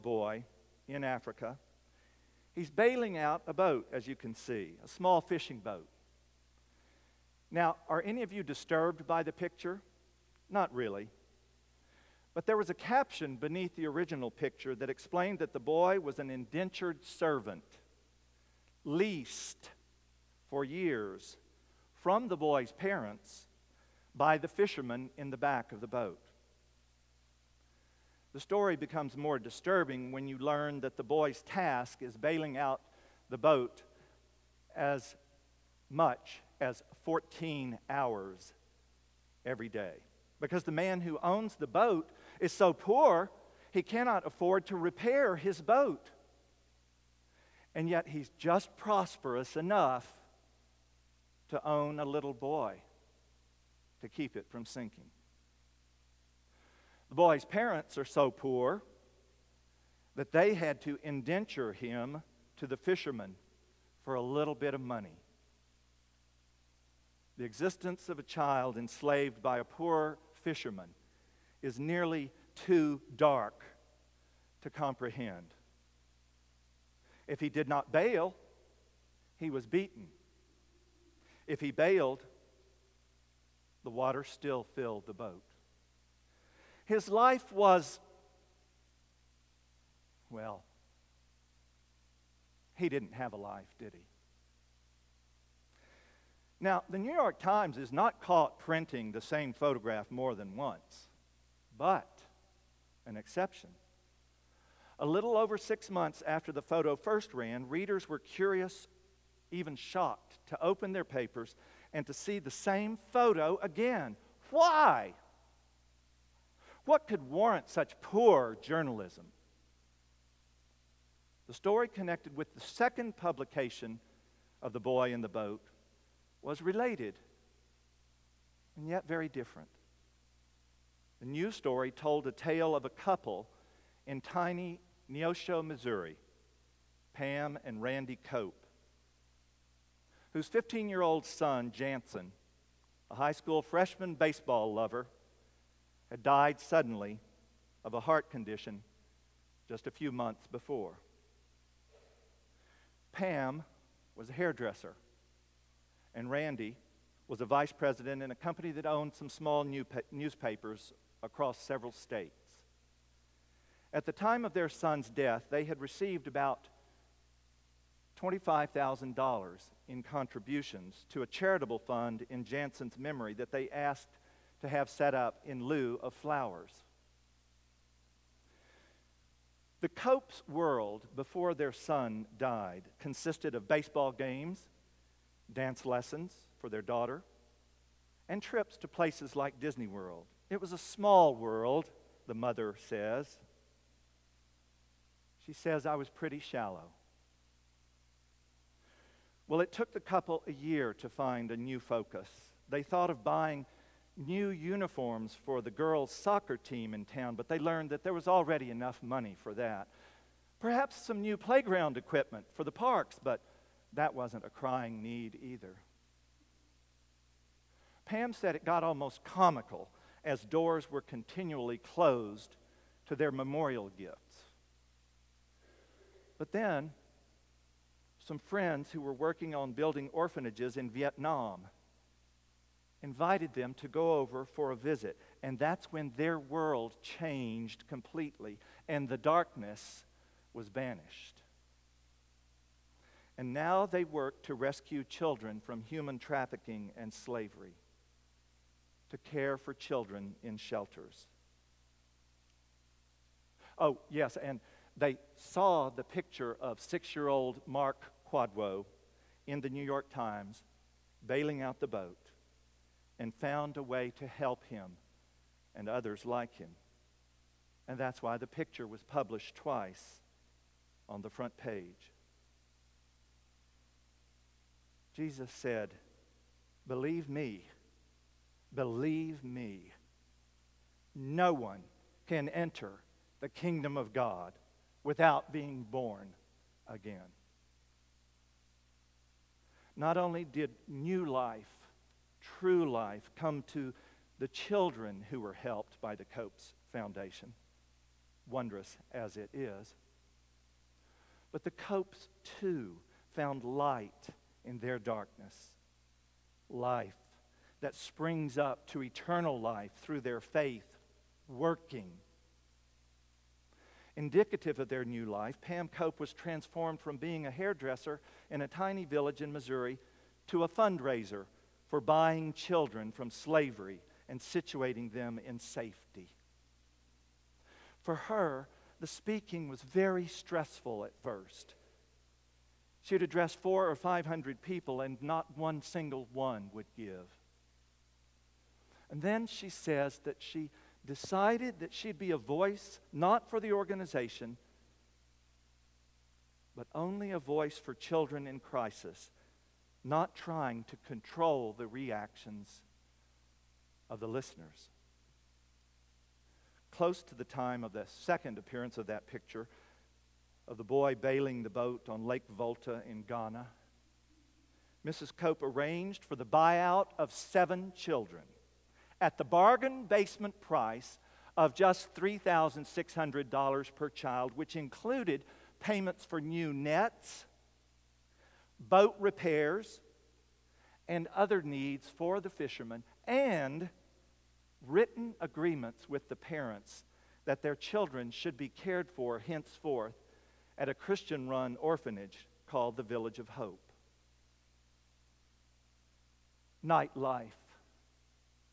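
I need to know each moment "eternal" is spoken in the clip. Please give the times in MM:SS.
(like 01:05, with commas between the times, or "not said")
05:09.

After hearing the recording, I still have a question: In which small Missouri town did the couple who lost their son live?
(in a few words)
Neosho.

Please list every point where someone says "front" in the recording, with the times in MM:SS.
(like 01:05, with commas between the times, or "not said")
04:31.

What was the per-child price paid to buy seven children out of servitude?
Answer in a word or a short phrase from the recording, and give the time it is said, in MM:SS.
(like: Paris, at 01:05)
$3,600, at 06:12.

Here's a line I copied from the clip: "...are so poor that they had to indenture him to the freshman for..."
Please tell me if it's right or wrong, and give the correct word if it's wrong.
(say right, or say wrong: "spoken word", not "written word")
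wrong: "fisherman", not "freshman".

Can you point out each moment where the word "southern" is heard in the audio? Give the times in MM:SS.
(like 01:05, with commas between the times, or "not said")
not said.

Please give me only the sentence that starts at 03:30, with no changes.
Perhaps some new playground equipment for the parks, but that wasn't a crying need either.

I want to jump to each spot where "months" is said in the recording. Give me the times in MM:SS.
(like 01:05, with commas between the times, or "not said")
01:45, 02:30.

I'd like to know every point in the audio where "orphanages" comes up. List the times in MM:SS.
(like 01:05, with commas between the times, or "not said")
03:50, 06:31.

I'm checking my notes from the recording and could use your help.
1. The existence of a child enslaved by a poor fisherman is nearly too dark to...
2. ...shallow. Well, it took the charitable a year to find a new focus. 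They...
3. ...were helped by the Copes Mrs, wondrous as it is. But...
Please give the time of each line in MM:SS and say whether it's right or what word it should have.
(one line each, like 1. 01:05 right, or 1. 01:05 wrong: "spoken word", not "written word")
1. 01:07 right
2. 03:16 wrong: "couple", not "charitable"
3. 04:55 wrong: "Foundation", not "Mrs".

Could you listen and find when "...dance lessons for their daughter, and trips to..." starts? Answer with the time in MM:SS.
03:05.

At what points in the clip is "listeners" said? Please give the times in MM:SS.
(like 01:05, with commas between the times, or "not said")
05:54.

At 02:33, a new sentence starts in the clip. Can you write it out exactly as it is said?
Pam was a hairdresser, and Randy was a vice president in a company that owned some small new newspapers across several states.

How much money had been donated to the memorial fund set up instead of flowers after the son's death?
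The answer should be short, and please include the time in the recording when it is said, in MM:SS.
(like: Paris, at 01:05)
$25,000, at 02:48.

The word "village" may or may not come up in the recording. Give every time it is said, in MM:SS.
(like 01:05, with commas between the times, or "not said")
05:19, 06:33.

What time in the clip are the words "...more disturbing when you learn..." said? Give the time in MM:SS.
00:29.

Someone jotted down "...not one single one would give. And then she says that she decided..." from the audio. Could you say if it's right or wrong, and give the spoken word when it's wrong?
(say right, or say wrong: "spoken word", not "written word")
right.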